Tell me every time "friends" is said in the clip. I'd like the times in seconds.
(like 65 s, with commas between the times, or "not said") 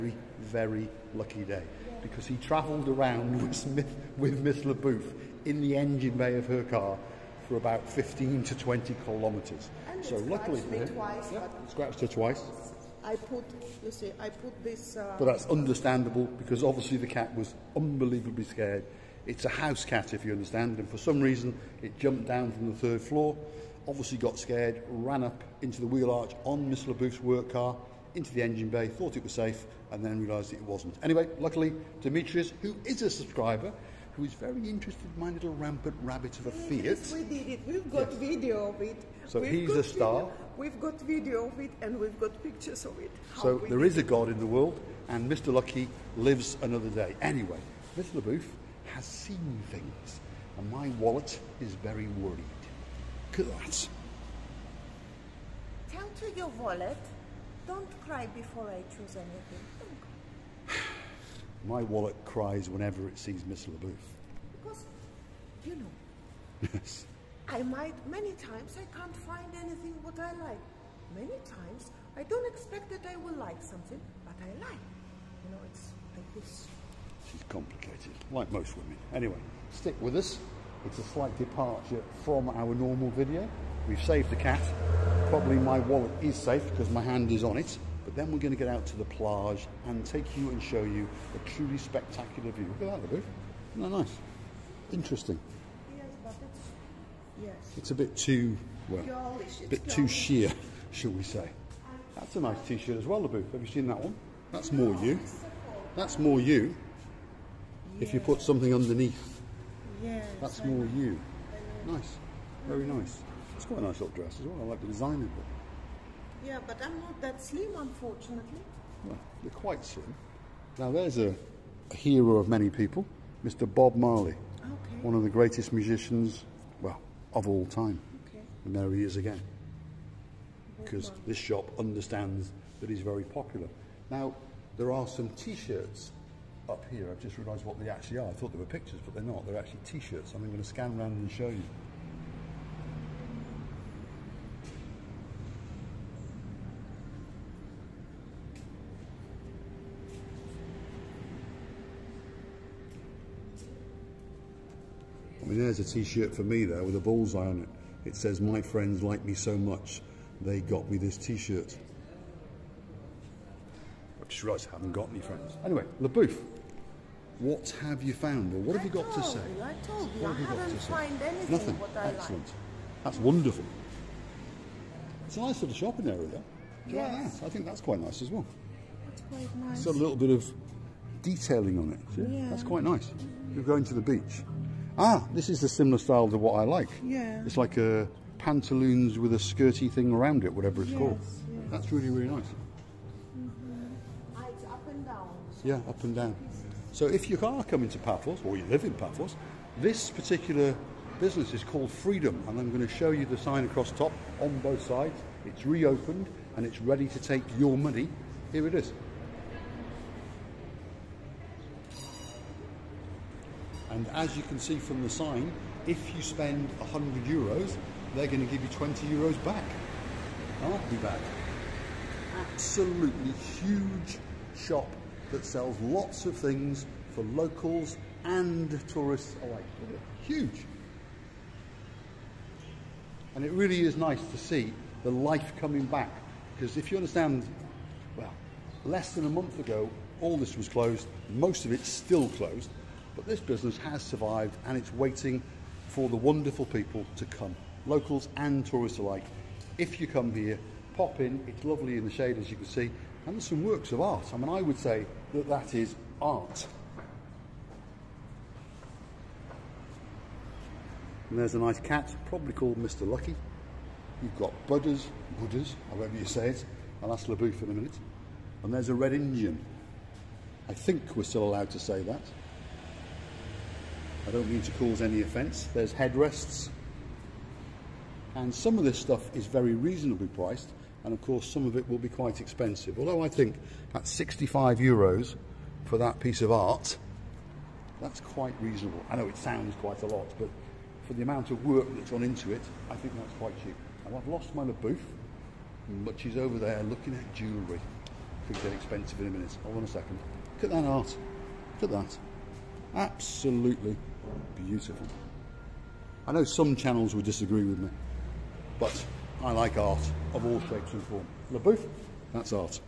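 158 s, 165 s.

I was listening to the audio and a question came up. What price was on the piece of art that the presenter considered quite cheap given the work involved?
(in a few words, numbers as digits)
65 euros.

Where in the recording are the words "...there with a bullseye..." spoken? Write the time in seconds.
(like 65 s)
156 s.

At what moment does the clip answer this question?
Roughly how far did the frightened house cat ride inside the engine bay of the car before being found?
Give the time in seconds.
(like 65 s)
7 s.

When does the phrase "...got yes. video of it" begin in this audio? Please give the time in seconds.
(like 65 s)
37 s.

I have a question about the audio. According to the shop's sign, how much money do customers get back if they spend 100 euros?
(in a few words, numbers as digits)
20 euros.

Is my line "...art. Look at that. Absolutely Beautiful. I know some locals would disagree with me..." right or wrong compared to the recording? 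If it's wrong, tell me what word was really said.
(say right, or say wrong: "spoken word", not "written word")
wrong: "channels", not "locals".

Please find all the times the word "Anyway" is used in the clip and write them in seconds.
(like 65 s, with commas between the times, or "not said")
31 s, 47 s, 79 s, 165 s.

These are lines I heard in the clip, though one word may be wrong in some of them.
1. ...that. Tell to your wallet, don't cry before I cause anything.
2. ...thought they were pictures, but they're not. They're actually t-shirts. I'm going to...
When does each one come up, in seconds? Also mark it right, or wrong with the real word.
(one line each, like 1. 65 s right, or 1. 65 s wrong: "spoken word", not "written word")
1. 53 s wrong: "choose", not "cause"
2. 138 s right.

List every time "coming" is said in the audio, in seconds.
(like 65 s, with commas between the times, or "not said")
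197 s, 235 s.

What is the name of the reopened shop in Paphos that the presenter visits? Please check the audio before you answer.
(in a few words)
Freedom.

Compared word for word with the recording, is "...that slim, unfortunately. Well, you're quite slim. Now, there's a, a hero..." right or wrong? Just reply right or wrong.
right.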